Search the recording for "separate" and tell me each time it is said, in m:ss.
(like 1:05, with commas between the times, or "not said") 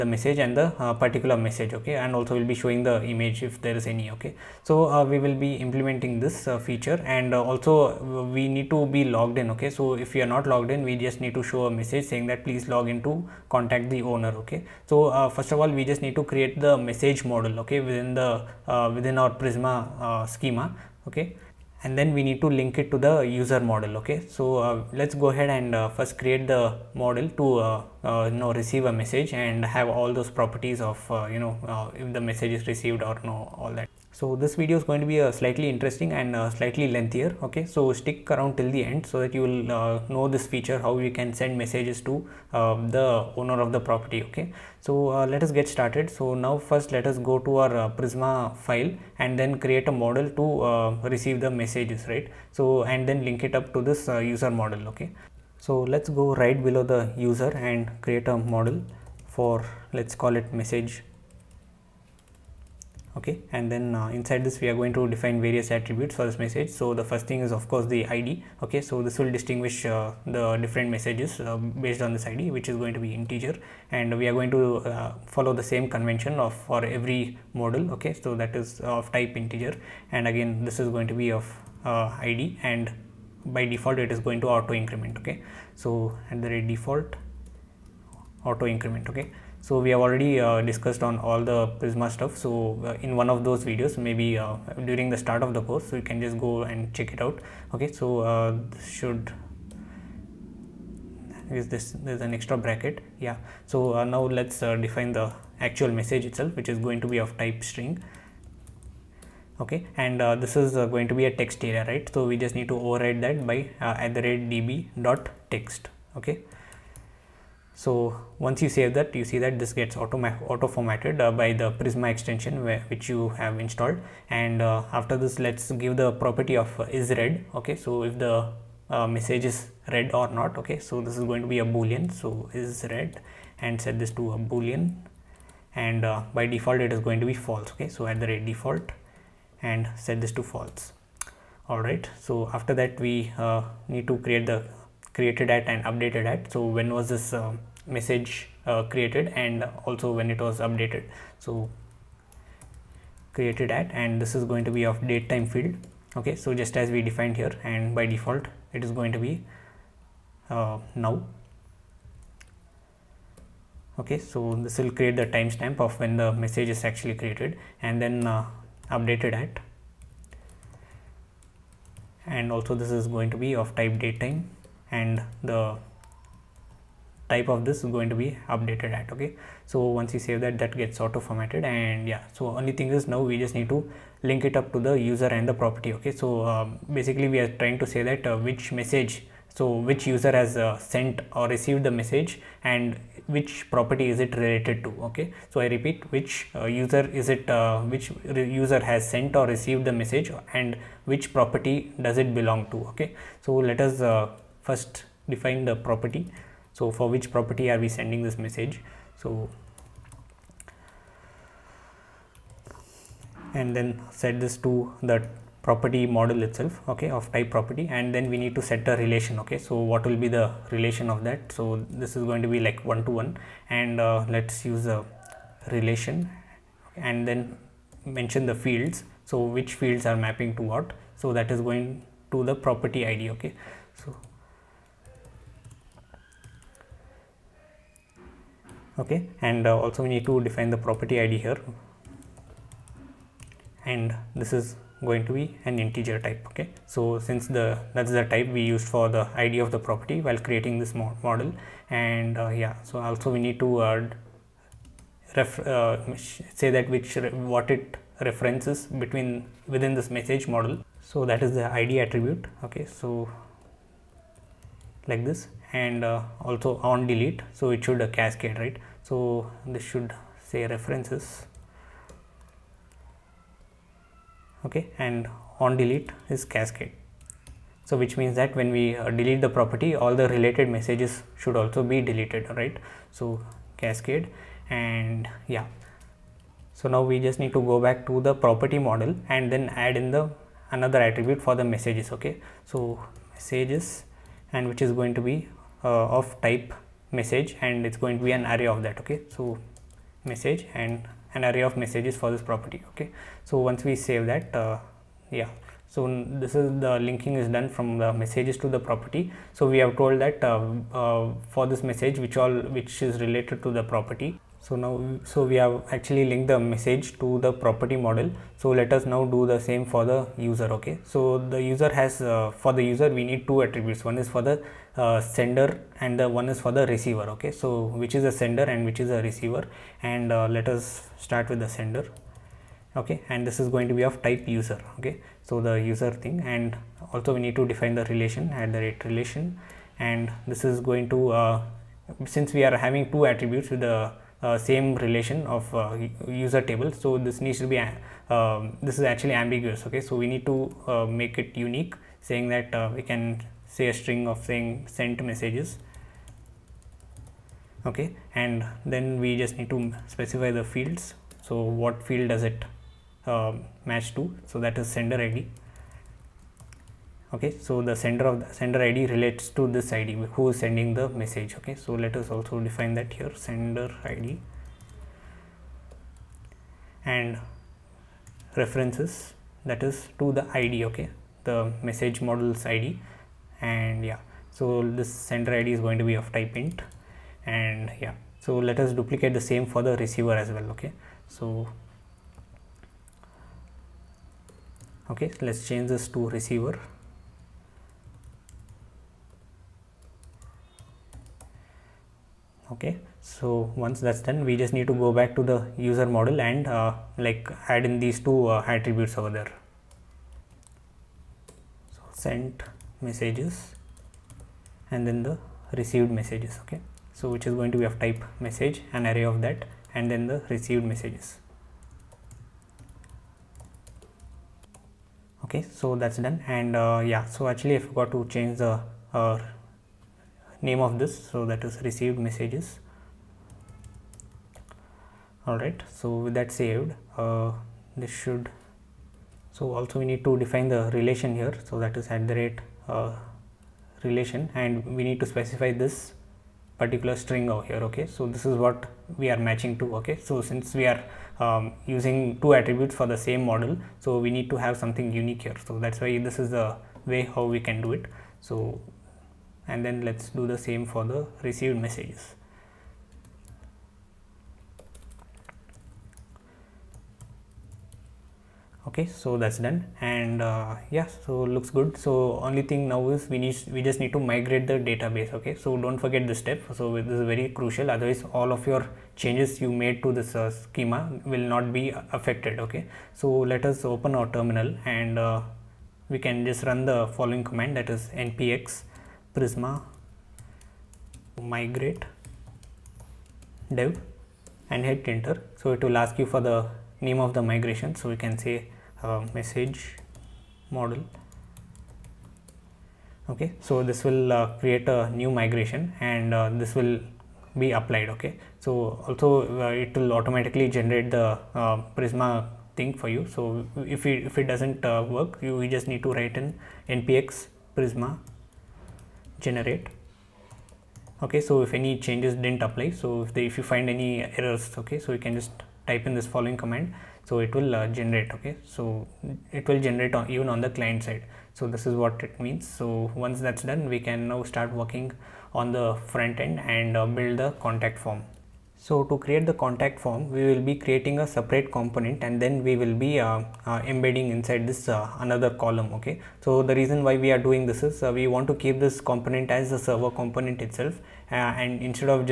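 9:01.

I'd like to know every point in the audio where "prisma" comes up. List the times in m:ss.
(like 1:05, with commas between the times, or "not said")
0:19, 0:48, 1:31, 2:01, 8:09, 8:31, 8:37.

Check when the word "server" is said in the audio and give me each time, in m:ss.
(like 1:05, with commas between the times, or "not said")
9:09.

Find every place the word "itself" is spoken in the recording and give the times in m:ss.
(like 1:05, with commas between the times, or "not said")
1:46, 3:36, 9:10.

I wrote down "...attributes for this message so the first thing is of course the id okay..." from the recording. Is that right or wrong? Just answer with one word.
right.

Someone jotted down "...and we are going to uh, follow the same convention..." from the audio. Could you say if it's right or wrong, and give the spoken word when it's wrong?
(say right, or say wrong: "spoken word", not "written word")
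right.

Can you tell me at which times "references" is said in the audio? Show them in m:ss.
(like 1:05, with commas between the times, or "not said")
4:18, 4:30, 6:18.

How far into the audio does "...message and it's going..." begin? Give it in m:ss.
4:57.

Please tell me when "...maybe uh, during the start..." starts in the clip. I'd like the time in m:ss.
1:33.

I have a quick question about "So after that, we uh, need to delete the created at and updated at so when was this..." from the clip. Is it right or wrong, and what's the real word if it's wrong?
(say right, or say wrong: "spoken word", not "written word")
wrong: "create", not "delete".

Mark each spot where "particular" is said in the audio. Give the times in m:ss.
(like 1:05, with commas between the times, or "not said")
0:01, 7:26.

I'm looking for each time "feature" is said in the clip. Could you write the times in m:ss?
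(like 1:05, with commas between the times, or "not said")
0:06, 0:40.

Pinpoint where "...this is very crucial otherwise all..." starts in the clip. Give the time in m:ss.
7:56.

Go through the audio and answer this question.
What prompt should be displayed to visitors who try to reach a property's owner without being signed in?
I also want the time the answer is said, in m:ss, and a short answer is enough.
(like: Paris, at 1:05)
Please log in to contact the owner, at 0:12.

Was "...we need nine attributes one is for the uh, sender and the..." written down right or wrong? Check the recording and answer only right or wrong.
wrong.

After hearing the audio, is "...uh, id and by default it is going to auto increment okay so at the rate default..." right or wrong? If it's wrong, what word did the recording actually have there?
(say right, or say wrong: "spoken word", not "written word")
right.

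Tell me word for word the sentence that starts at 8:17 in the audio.
So we can say uh, message model.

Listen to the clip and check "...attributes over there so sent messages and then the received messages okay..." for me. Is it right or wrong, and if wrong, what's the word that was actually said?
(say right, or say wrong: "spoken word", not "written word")
right.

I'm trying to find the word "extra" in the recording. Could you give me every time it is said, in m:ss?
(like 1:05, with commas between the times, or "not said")
1:42.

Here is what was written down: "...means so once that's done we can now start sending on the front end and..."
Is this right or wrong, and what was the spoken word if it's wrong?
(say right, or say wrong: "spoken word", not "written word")
wrong: "working", not "sending".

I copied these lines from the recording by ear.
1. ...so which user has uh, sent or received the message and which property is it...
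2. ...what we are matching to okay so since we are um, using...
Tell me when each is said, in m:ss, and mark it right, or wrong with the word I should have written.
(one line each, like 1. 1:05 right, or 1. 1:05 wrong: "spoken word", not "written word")
1. 3:09 right
2. 7:28 right.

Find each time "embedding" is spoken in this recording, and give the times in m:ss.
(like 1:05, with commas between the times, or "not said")
9:03.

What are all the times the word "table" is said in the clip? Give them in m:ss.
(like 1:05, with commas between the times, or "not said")
5:46.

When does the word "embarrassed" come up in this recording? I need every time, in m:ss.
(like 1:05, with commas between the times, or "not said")
not said.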